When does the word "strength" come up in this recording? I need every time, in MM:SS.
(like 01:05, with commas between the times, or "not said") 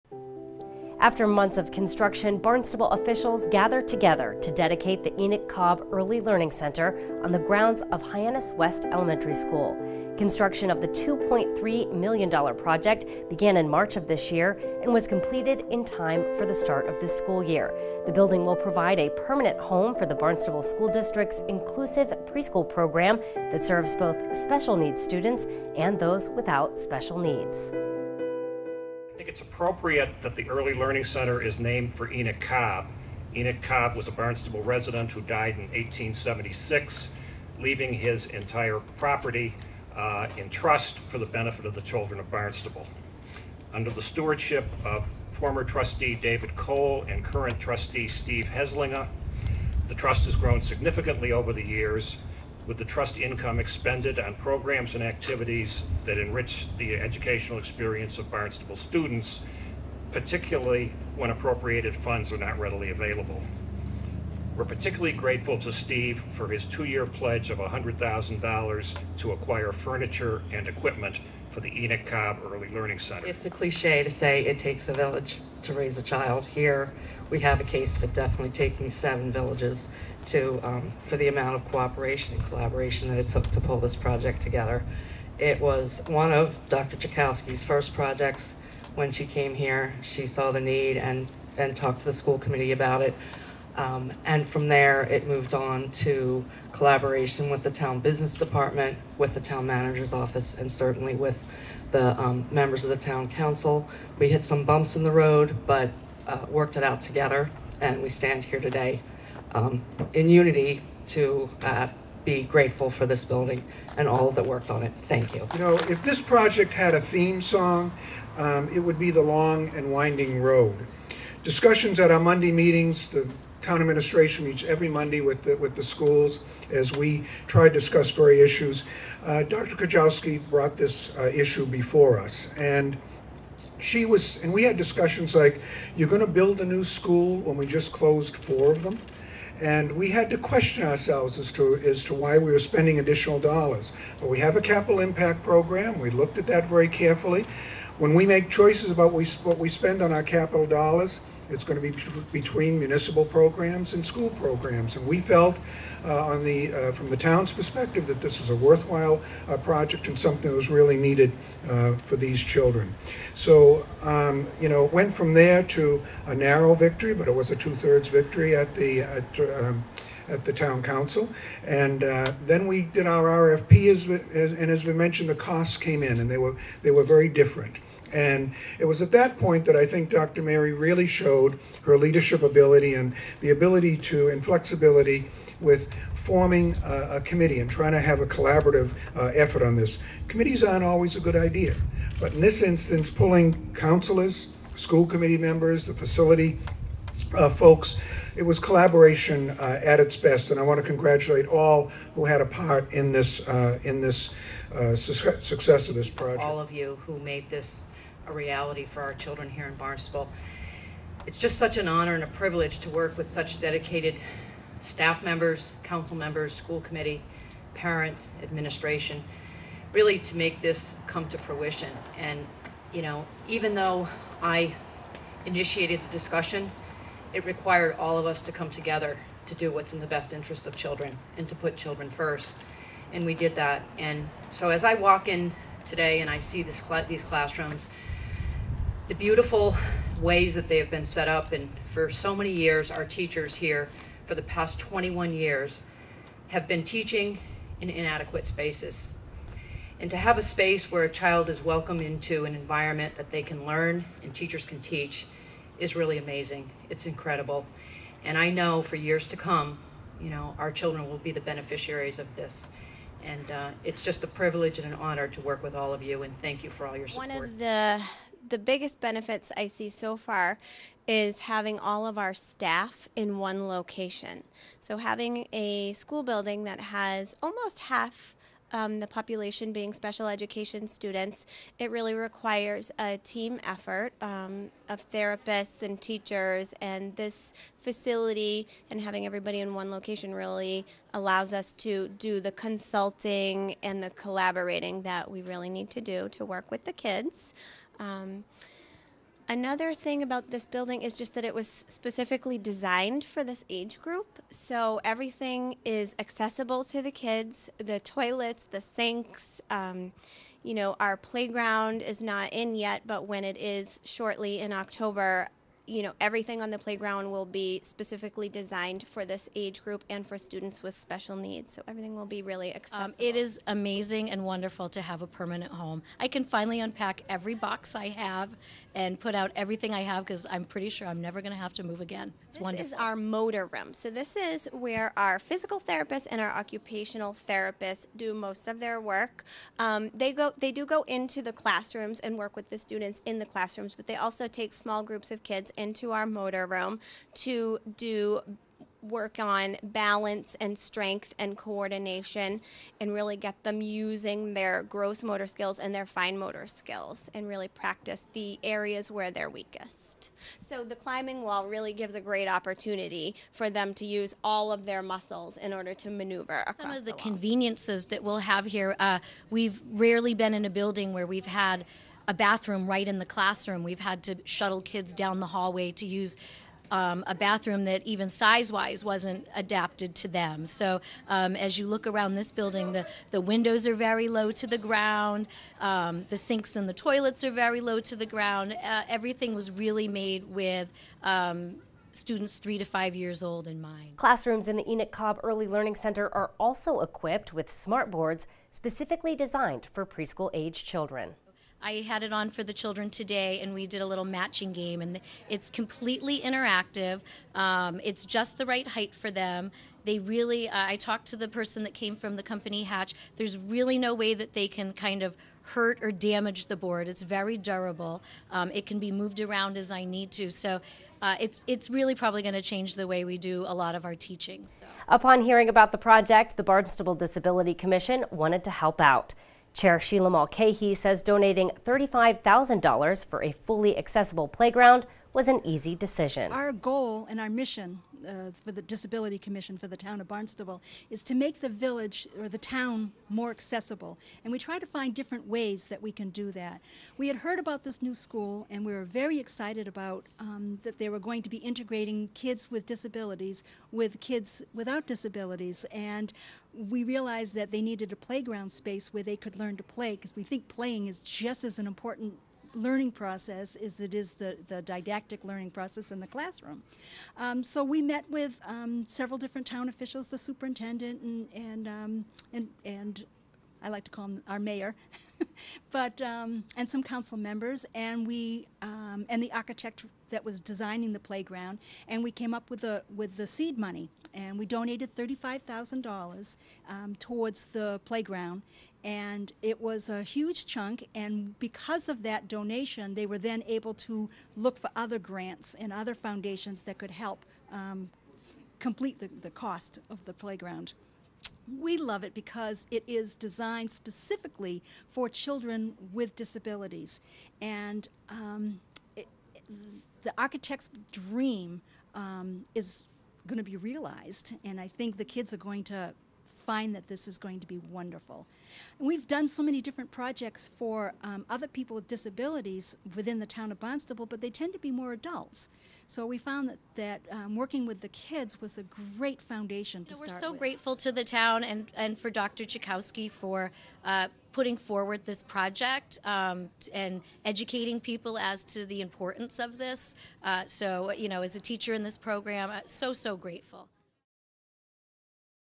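05:50.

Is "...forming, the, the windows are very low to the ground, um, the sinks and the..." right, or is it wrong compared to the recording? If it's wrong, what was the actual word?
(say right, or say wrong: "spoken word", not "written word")
wrong: "building", not "forming".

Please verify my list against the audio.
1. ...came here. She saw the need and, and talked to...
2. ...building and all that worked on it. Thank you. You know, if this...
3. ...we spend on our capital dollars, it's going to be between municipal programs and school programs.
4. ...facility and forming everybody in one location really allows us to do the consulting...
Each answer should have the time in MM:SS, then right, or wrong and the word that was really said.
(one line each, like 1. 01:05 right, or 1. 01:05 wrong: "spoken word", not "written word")
1. 01:29 right
2. 01:53 right
3. 02:29 right
4. 04:47 wrong: "having", not "forming".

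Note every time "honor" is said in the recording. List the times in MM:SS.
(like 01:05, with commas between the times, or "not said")
03:31, 04:24.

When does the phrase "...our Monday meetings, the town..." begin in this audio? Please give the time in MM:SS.
02:02.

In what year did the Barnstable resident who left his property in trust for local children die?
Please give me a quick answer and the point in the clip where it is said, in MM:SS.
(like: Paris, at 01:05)
1876, at 00:35.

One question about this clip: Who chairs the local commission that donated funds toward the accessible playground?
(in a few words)
Sheila Mulcahy.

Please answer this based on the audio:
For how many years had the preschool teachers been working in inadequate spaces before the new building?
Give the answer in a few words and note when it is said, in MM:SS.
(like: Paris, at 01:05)
21, at 04:04.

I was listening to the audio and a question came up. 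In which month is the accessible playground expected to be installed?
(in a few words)
October.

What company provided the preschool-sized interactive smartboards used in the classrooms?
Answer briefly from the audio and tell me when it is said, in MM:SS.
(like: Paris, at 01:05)
Hatch, at 06:52.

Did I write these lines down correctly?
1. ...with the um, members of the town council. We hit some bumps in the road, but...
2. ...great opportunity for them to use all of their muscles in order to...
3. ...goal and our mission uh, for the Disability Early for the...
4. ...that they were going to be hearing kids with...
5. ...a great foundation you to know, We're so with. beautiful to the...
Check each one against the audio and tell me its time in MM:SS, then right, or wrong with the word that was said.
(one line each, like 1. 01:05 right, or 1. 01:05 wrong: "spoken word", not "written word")
1. 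01:41 right
2. 06:02 right
3. 07:16 wrong: "Commission", not "Early"
4. 07:30 wrong: "integrating", not "hearing"
5. 08:48 wrong: "grateful", not "beautiful".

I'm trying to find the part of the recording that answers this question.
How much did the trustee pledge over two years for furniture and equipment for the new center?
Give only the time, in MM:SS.
01:07.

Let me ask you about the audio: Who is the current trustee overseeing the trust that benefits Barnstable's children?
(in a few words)
Steve Heslinger.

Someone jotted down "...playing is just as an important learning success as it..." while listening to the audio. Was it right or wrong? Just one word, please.
wrong.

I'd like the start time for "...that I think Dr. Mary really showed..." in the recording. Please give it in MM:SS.
02:59.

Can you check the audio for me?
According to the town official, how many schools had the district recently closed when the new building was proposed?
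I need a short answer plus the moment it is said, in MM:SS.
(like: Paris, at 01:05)
4, at 02:18.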